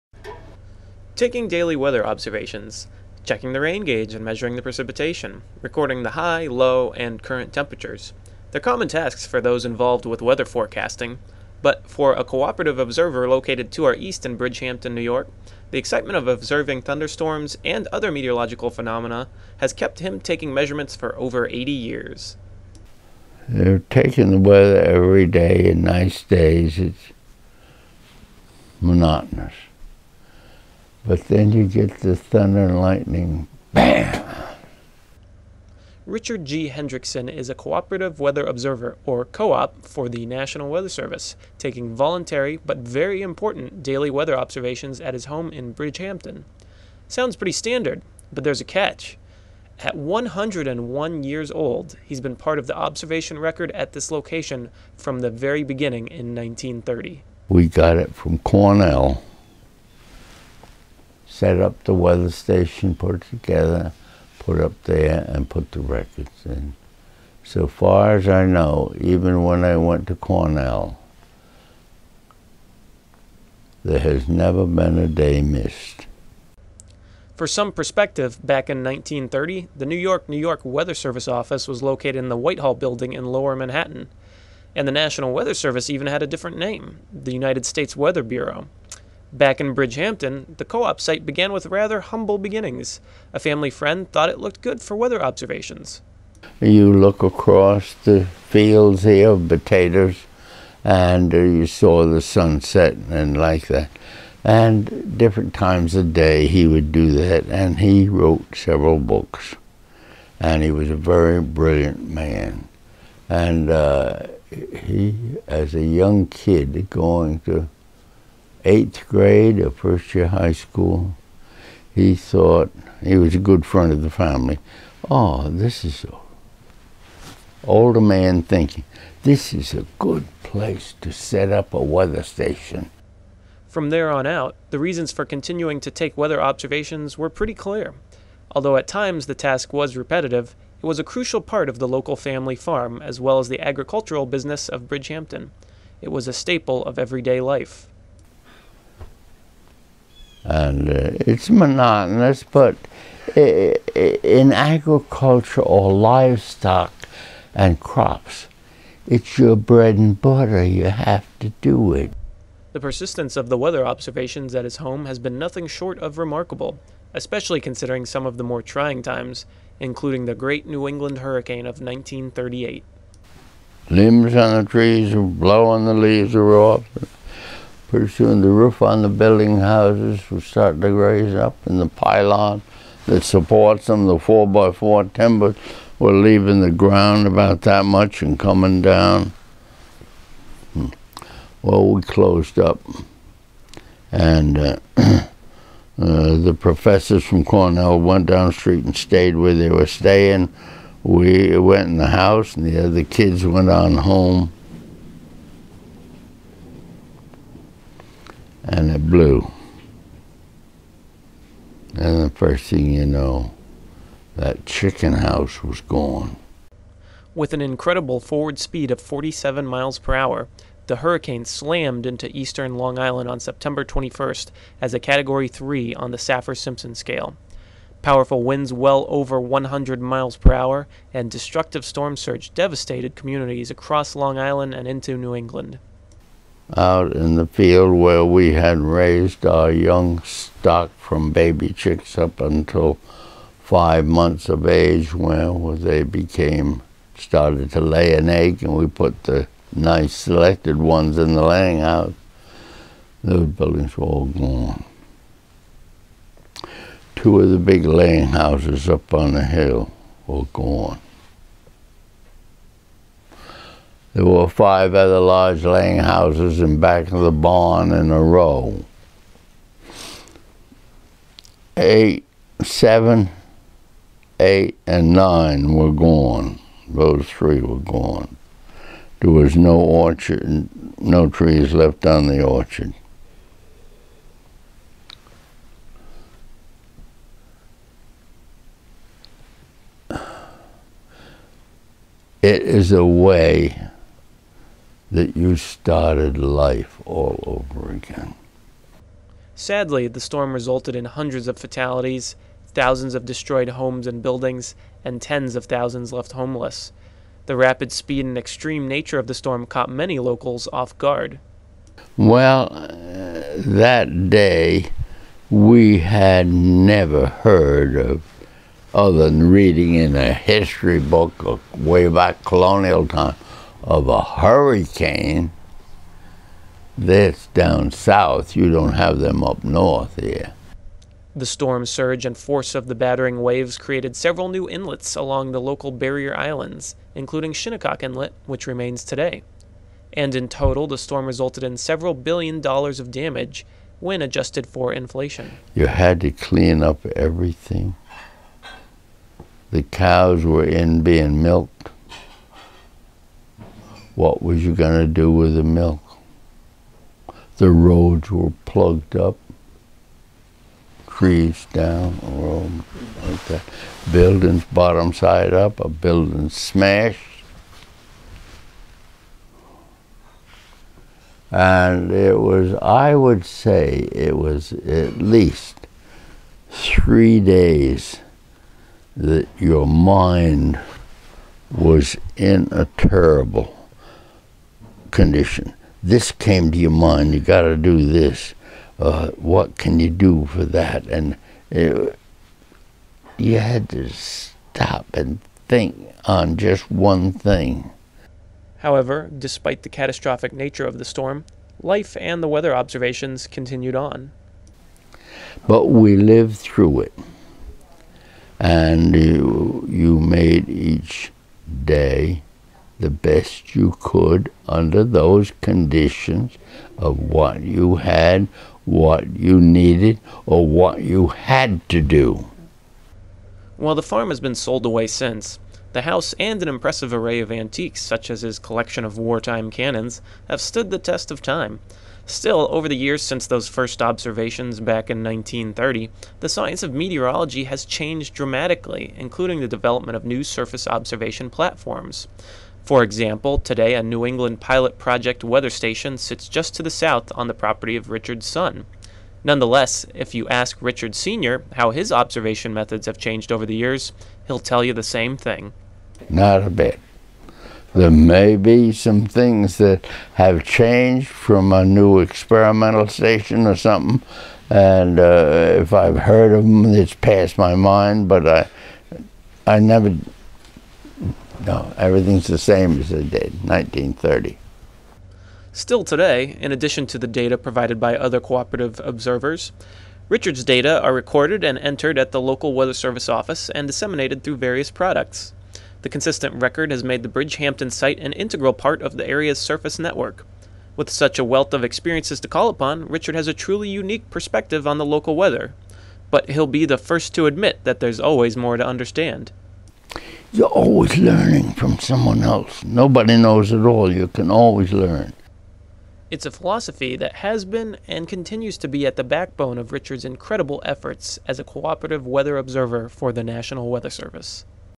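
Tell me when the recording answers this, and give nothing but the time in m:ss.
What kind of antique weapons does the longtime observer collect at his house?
7:09.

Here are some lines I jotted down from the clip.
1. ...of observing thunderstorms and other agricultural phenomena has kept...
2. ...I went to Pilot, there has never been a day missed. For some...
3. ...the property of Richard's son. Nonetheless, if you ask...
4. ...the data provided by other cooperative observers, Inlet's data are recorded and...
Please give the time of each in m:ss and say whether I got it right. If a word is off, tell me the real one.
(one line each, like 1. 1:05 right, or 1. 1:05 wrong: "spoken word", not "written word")
1. 0:16 wrong: "meteorological", not "agricultural"
2. 1:09 wrong: "Cornell", not "Pilot"
3. 7:27 right
4. 7:57 wrong: "Richard", not "Inlet".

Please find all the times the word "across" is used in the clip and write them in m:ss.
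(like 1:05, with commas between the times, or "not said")
1:37, 3:53.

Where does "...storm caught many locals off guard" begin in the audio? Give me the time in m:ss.
5:09.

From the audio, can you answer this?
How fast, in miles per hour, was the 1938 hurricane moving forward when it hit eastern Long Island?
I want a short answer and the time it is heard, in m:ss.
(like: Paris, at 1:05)
47, at 3:39.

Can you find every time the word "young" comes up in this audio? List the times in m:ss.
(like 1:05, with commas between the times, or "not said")
1:55, 3:59.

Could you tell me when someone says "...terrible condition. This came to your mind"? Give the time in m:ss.
6:22.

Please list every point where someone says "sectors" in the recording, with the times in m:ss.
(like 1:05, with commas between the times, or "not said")
not said.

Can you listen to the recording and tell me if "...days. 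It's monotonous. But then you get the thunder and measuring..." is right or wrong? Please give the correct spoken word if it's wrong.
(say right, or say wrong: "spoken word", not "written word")
wrong: "lightning", not "measuring".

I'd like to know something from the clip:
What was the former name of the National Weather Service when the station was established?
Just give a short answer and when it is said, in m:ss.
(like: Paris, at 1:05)
United States Weather Bureau, at 1:27.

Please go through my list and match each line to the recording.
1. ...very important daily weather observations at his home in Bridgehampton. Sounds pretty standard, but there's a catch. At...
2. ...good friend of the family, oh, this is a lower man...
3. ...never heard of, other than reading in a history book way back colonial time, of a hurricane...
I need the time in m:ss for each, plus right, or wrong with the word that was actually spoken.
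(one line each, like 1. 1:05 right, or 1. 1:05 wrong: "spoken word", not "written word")
1. 0:42 right
2. 2:03 wrong: "older", not "lower"
3. 5:16 right.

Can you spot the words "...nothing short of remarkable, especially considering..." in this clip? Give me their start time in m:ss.
2:45.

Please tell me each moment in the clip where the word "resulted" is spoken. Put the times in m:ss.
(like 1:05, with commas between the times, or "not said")
5:00, 5:41.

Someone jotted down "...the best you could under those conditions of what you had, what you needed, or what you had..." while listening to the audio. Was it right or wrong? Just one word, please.
right.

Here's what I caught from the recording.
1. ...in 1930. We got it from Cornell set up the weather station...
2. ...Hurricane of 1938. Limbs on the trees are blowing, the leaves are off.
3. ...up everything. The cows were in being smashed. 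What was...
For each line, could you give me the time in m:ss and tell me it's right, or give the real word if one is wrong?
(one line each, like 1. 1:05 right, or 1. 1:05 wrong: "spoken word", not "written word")
1. 0:56 right
2. 2:51 right
3. 5:46 wrong: "milked", not "smashed".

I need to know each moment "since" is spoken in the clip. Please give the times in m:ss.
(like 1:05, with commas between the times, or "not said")
7:05, 7:13.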